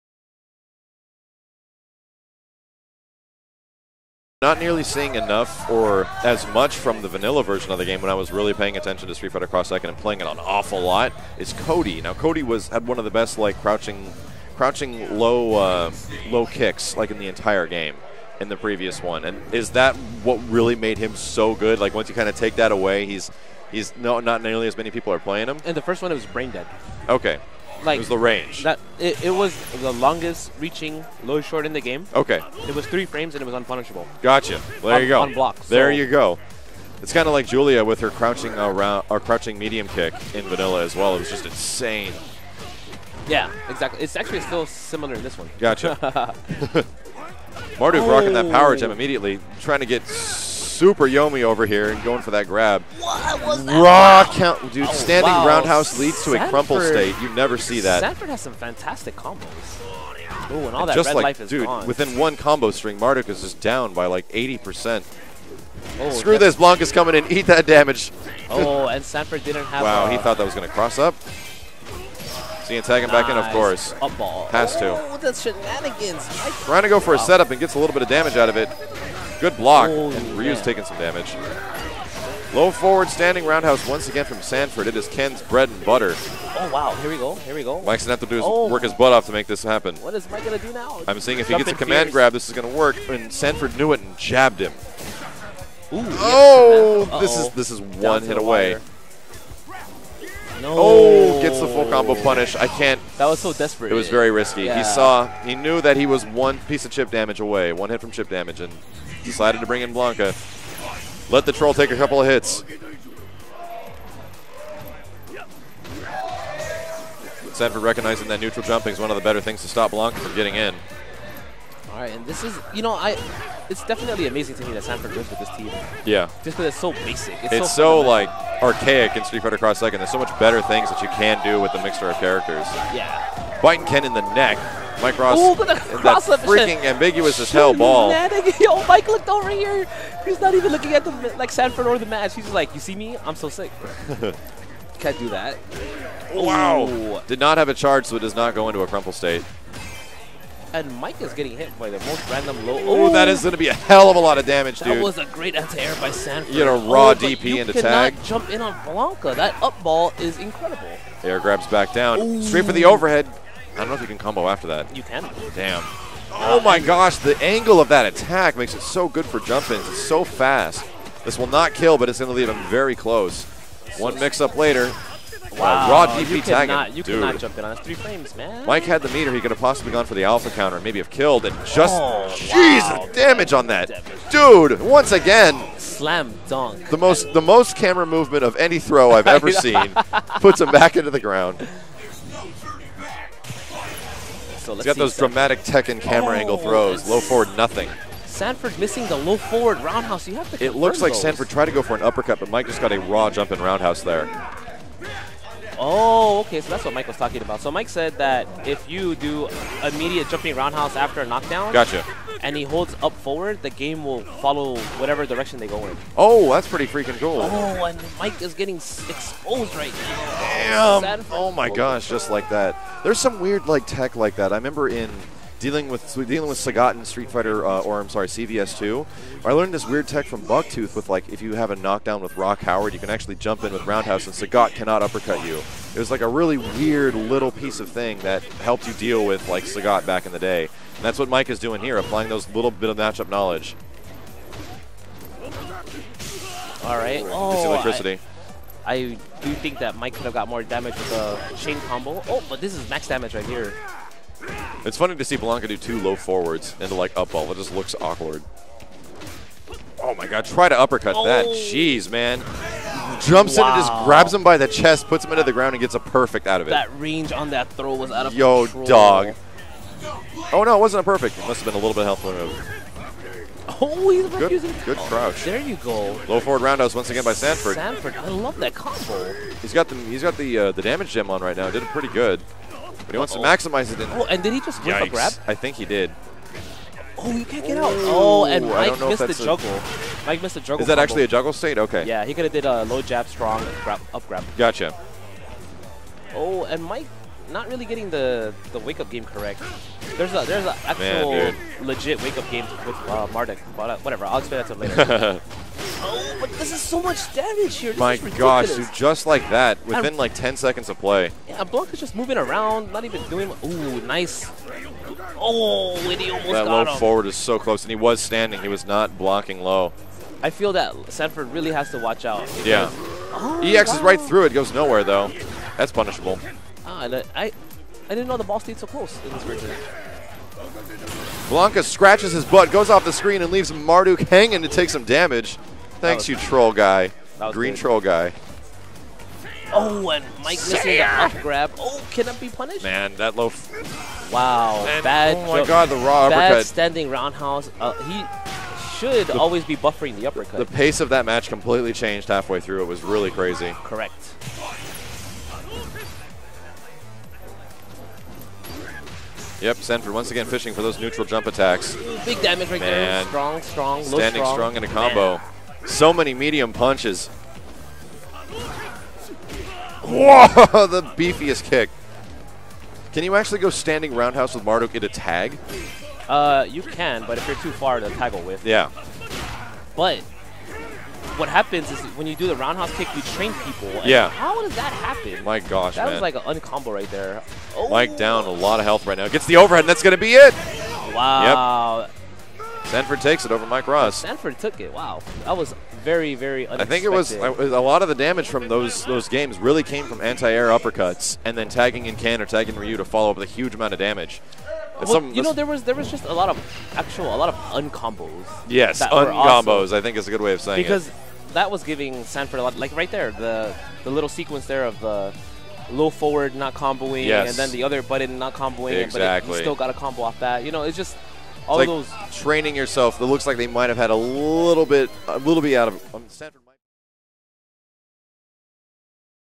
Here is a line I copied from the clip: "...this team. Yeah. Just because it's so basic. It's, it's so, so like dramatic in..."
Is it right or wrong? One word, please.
wrong.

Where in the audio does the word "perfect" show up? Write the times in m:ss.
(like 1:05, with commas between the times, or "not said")
4:25, 4:31.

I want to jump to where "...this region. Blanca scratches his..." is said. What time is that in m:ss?
5:29.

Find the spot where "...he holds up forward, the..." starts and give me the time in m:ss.
3:32.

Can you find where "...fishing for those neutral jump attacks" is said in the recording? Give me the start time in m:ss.
6:00.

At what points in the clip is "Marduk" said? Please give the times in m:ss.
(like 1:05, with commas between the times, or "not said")
0:47, 1:02, 5:03, 5:33, 6:14.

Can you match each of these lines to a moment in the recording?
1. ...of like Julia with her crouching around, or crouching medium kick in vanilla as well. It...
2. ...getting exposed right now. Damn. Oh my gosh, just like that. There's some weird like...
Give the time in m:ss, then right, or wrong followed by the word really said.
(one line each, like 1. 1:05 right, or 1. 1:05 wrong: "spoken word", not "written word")
1. 0:37 right
2. 3:38 right.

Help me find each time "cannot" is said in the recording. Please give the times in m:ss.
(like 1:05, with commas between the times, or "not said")
2:57, 3:54.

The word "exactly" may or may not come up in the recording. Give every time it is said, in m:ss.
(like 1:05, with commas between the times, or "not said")
0:43, 6:59.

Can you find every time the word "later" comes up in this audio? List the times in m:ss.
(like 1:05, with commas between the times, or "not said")
2:54, 5:04.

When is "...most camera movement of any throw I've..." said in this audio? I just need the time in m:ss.
3:07.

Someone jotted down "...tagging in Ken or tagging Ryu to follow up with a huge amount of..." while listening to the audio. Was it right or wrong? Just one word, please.
right.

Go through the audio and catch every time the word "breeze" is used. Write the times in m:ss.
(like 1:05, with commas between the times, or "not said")
not said.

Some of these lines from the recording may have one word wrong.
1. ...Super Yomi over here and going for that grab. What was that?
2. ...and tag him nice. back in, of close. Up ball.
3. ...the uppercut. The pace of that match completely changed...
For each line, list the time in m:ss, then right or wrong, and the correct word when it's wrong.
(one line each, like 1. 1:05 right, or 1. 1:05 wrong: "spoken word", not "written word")
1. 0:50 right
2. 1:12 wrong: "course", not "close"
3. 5:50 right.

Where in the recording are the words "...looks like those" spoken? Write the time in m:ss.
3:20.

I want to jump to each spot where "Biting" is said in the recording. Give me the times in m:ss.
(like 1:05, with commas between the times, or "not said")
2:13.